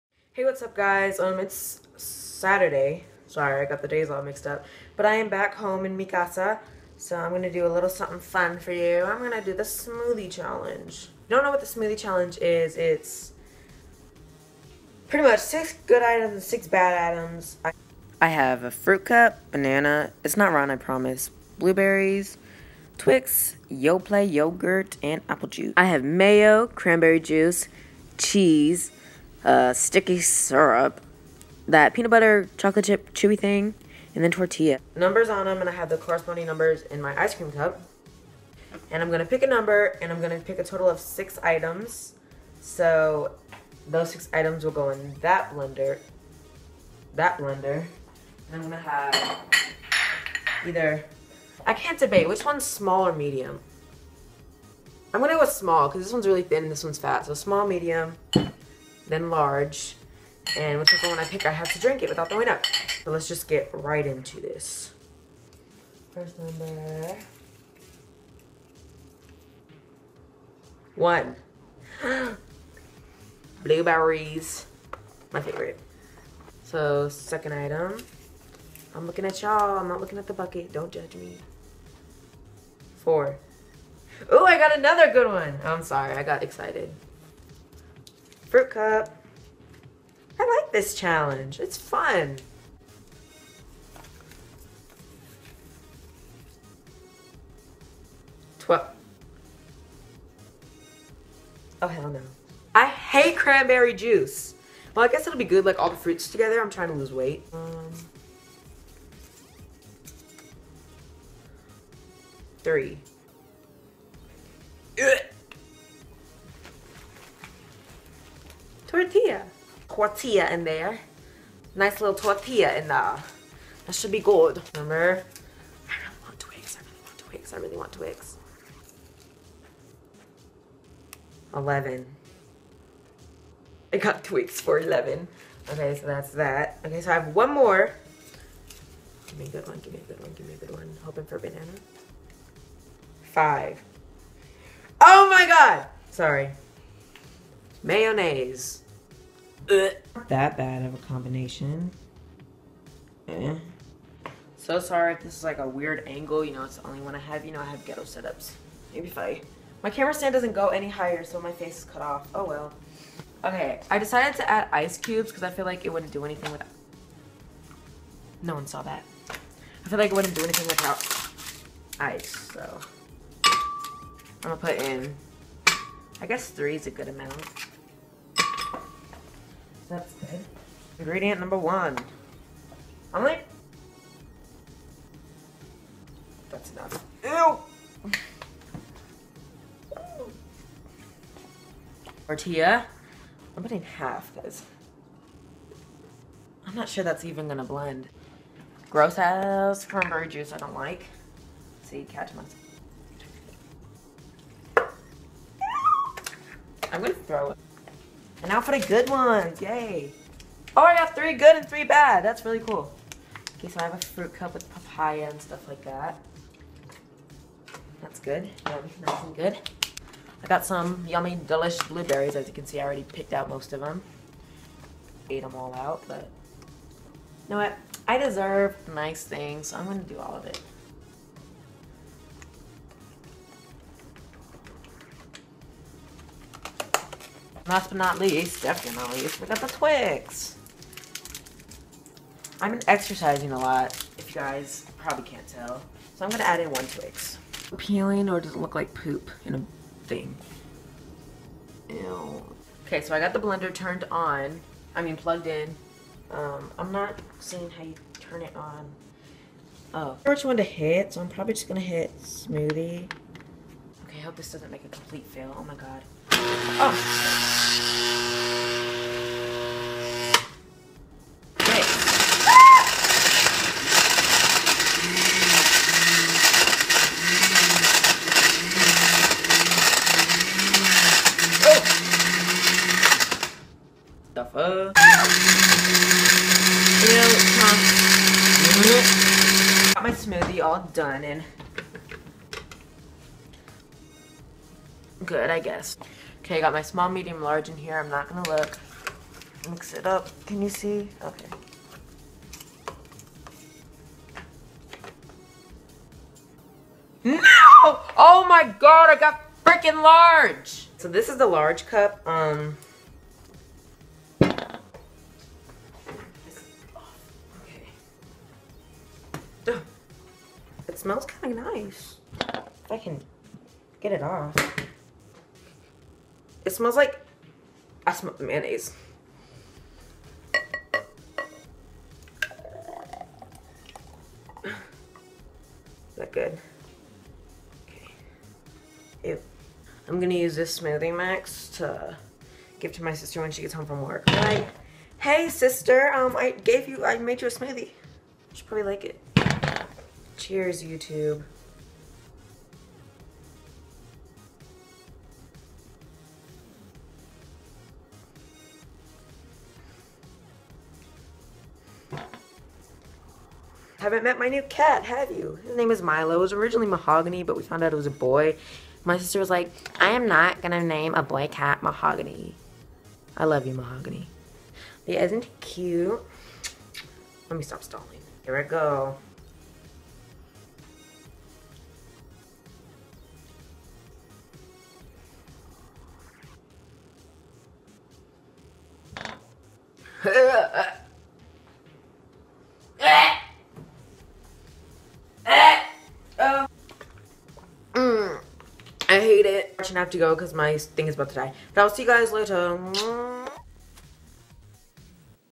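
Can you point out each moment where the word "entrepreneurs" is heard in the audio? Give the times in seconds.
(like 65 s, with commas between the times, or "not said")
not said.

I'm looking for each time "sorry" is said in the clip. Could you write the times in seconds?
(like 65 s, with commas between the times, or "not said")
3 s, 85 s, 146 s, 154 s.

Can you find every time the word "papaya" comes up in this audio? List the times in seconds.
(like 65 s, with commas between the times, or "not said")
214 s.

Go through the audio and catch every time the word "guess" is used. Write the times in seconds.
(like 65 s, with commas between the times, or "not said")
105 s, 176 s, 295 s.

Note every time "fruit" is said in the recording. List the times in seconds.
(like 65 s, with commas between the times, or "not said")
18 s, 88 s, 105 s, 213 s.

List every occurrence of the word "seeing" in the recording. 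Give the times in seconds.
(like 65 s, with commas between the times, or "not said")
257 s.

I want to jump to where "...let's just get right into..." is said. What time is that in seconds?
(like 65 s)
63 s.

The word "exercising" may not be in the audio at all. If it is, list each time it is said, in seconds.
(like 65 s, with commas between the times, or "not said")
242 s.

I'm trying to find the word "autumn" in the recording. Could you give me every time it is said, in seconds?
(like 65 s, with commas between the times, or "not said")
not said.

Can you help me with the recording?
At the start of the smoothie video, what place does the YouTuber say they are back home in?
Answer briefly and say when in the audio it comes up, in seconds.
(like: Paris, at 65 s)
Mikasa, at 5 s.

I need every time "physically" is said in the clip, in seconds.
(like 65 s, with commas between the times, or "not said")
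not said.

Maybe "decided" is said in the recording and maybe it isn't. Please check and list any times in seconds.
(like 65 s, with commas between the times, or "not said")
163 s.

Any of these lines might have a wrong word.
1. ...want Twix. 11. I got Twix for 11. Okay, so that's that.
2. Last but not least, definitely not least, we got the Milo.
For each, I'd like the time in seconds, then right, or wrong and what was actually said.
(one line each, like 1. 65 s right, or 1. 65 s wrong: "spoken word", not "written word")
1. 127 s right
2. 237 s wrong: "Twix", not "Milo".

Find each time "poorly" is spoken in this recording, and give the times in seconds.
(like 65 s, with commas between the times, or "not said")
not said.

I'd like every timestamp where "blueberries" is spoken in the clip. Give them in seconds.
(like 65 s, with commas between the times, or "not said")
21 s, 73 s, 221 s.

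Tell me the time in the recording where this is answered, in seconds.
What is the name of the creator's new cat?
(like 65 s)
366 s.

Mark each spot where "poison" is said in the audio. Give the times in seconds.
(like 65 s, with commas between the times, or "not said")
not said.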